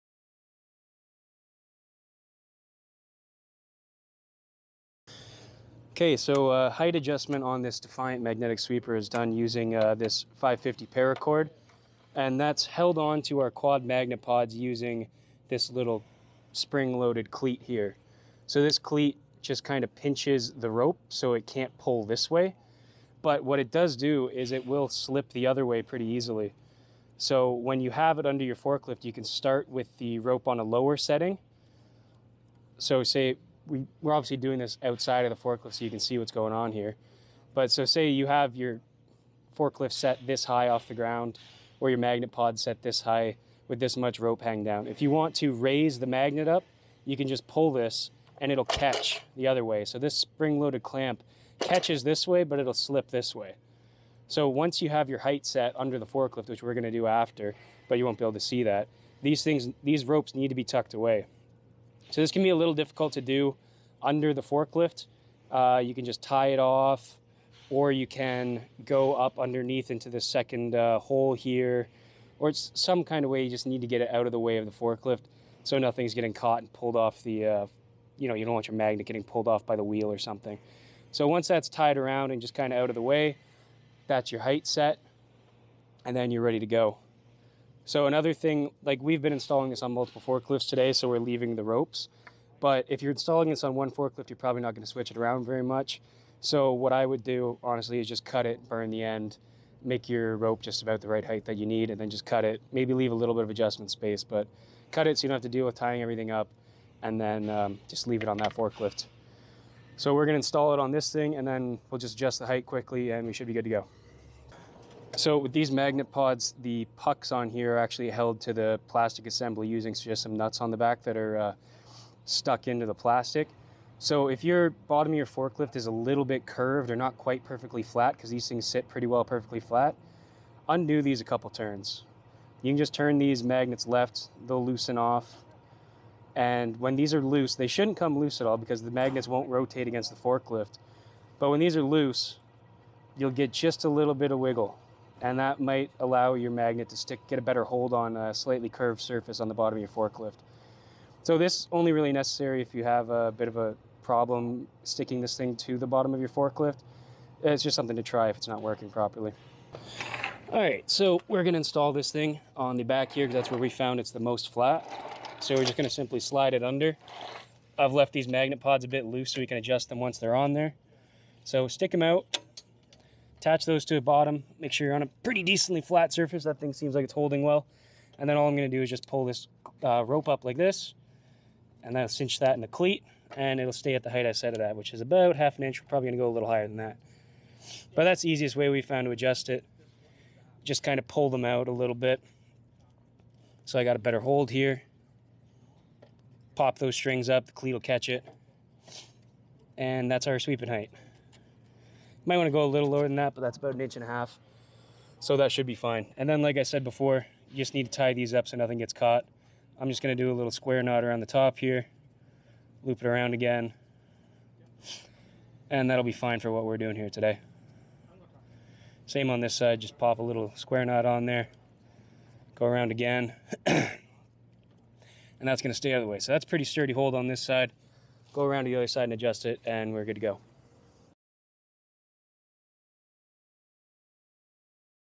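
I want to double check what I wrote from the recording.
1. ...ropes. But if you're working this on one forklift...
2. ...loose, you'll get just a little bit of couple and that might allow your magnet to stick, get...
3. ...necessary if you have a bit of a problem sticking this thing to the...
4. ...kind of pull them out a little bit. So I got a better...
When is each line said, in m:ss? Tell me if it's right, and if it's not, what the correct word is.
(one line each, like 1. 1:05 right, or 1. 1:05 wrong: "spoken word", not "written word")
1. 1:31 wrong: "installing", not "working"
2. 2:21 wrong: "wiggle", not "couple"
3. 2:32 right
4. 3:10 right.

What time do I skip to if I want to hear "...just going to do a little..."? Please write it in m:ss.
3:29.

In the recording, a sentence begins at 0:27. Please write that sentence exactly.
So when you have it under your forklift, you can start with the rope on a lower setting.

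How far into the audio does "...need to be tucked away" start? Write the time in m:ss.
1:00.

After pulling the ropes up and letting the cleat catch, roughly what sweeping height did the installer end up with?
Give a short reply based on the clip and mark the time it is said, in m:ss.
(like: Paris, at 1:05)
About 1.5 inches, at 3:23.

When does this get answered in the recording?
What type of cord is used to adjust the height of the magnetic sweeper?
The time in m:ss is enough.
0:10.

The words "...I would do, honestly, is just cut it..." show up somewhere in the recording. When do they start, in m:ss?
1:36.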